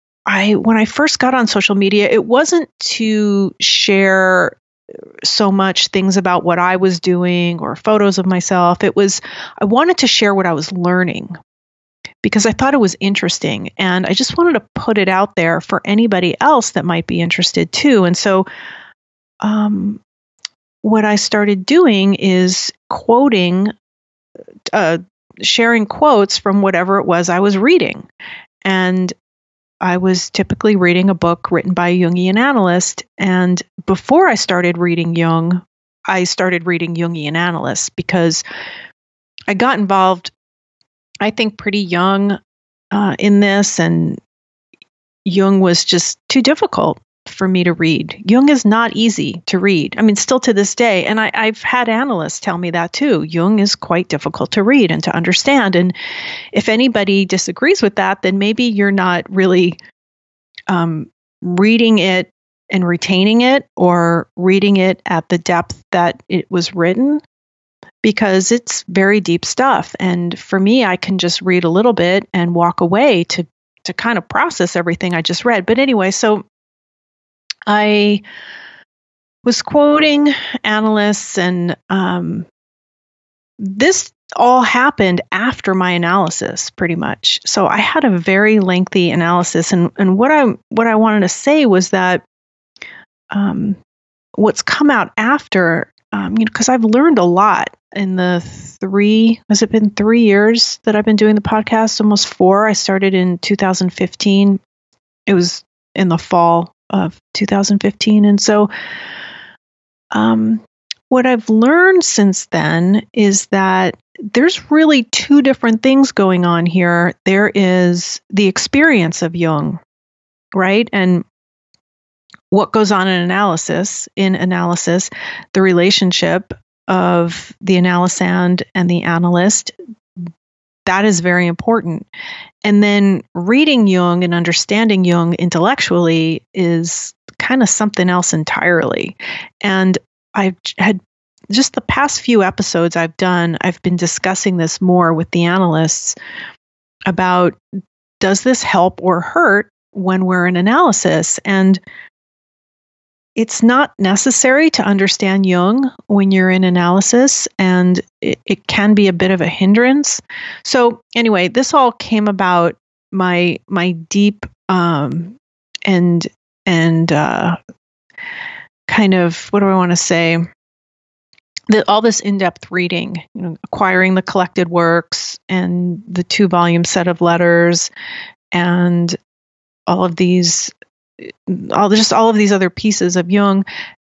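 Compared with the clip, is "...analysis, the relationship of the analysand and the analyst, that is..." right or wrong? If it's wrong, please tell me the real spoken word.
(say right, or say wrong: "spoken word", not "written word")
right.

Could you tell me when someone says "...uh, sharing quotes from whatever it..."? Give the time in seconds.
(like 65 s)
24 s.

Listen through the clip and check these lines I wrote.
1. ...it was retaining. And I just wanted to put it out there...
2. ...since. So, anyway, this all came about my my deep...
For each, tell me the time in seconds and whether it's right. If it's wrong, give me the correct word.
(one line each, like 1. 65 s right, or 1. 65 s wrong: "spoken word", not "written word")
1. 12 s wrong: "interesting", not "retaining"
2. 159 s wrong: "hindrance", not "since".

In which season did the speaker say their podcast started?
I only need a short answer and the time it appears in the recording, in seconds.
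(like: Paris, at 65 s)
Fall, at 106 s.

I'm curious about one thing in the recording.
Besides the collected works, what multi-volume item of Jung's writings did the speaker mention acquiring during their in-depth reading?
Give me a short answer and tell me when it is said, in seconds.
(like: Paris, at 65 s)
two-volume set of letters, at 176 s.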